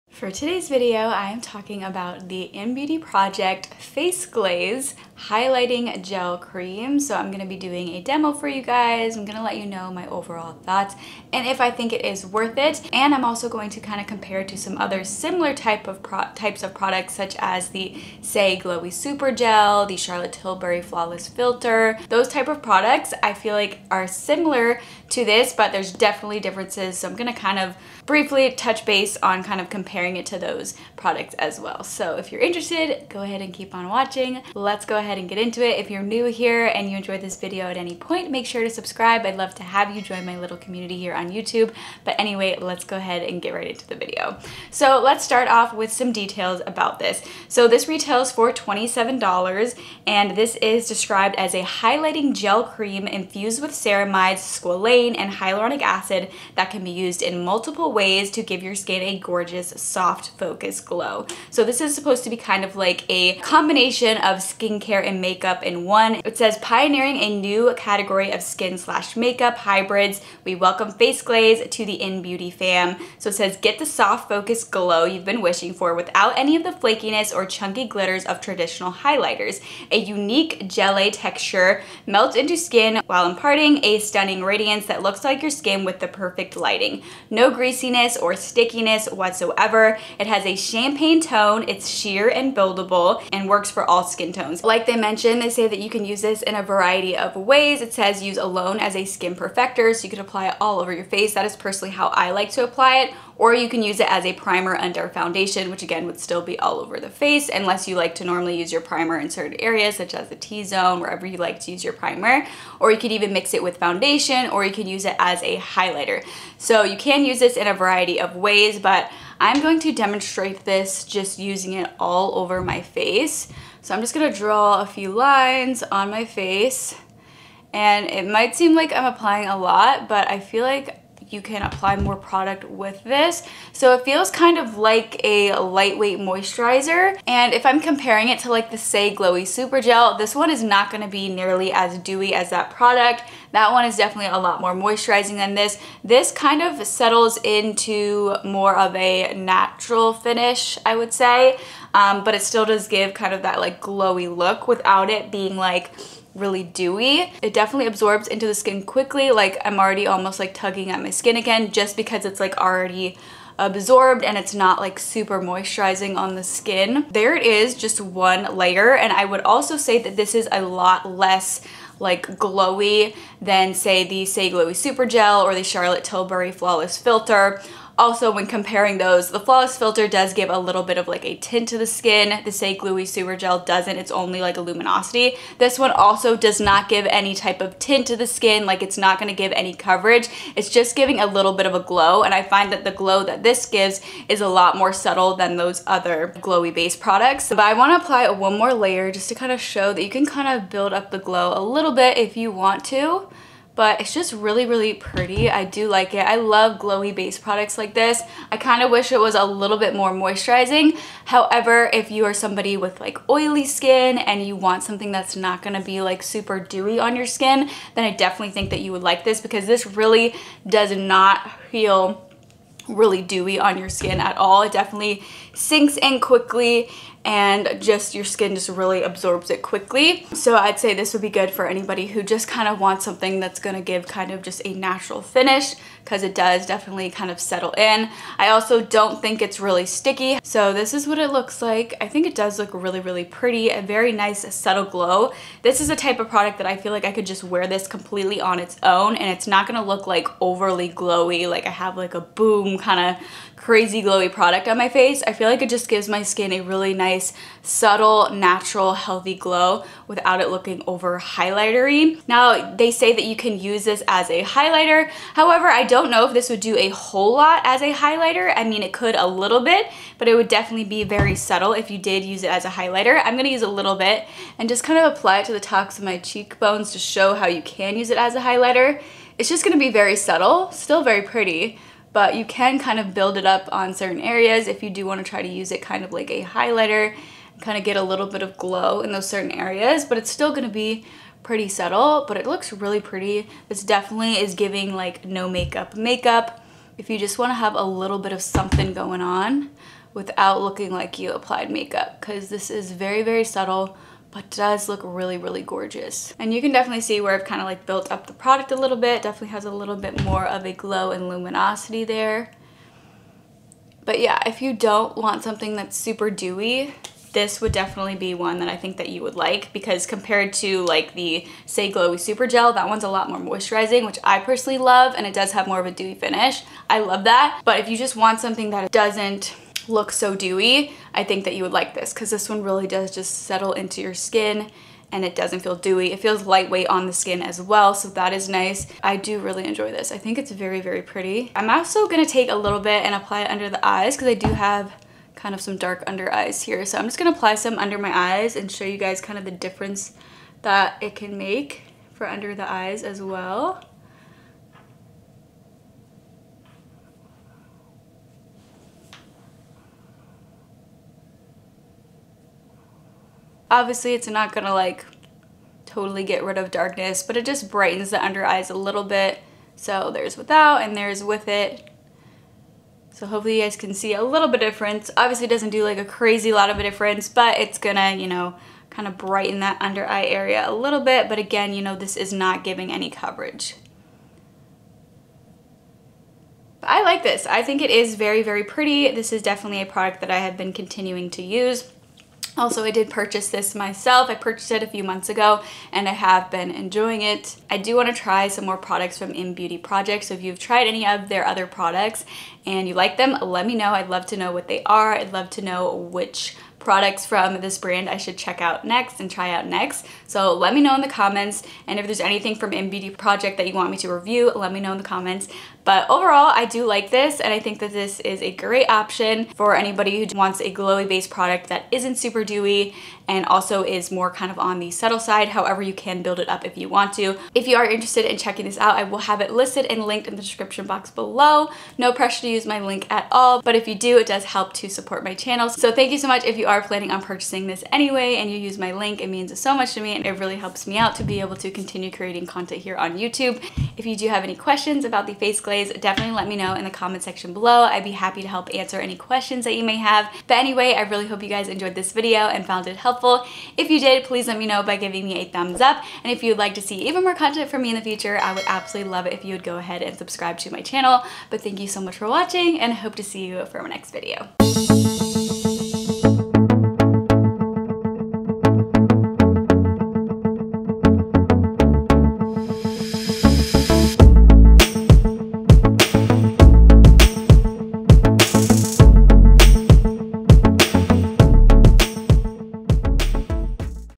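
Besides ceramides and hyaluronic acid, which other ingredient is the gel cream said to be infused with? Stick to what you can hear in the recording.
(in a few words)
squalane.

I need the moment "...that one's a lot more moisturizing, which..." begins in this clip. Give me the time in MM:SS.
05:22.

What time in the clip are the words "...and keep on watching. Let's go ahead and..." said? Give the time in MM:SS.
00:33.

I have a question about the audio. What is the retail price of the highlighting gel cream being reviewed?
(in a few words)
$27.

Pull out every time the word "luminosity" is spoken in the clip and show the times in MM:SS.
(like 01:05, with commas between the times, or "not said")
03:04, 05:11.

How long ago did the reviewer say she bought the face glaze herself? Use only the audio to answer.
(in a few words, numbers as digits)
a few months ago.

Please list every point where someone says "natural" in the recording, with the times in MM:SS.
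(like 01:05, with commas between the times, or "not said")
02:29, 03:54, 04:18.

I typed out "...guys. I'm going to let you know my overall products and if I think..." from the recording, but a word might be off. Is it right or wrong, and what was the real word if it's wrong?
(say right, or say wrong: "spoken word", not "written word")
wrong: "thoughts", not "products".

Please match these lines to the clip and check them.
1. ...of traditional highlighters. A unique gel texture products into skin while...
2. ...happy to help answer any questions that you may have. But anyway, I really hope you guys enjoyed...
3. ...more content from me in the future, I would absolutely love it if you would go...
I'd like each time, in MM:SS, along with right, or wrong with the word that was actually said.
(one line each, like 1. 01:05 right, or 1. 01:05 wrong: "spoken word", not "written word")
1. 01:18 wrong: "melts", not "products"
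2. 07:28 right
3. 07:37 right.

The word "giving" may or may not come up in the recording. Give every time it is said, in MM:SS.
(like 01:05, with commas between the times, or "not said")
03:10, 04:54, 06:22, 07:34.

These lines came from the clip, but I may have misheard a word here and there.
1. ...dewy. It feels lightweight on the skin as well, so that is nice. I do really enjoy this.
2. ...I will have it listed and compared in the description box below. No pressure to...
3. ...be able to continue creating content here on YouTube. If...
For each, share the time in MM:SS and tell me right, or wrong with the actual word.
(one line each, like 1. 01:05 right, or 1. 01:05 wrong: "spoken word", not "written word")
1. 05:35 right
2. 07:08 wrong: "linked", not "compared"
3. 07:21 right.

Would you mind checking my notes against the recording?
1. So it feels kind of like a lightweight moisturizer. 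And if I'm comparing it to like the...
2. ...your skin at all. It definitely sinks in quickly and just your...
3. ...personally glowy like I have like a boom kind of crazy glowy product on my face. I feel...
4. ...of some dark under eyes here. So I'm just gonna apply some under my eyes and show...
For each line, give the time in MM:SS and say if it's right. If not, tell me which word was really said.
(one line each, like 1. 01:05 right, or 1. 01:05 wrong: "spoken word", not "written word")
1. 02:13 right
2. 03:43 right
3. 04:10 wrong: "overly", not "personally"
4. 05:45 right.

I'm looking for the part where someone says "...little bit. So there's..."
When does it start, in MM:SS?
06:08.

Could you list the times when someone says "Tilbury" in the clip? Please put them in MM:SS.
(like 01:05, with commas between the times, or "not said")
00:20, 02:56.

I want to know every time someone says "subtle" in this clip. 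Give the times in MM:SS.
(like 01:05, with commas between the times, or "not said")
03:14, 04:04, 04:17, 04:31, 04:40, 04:51, 05:03, 07:04.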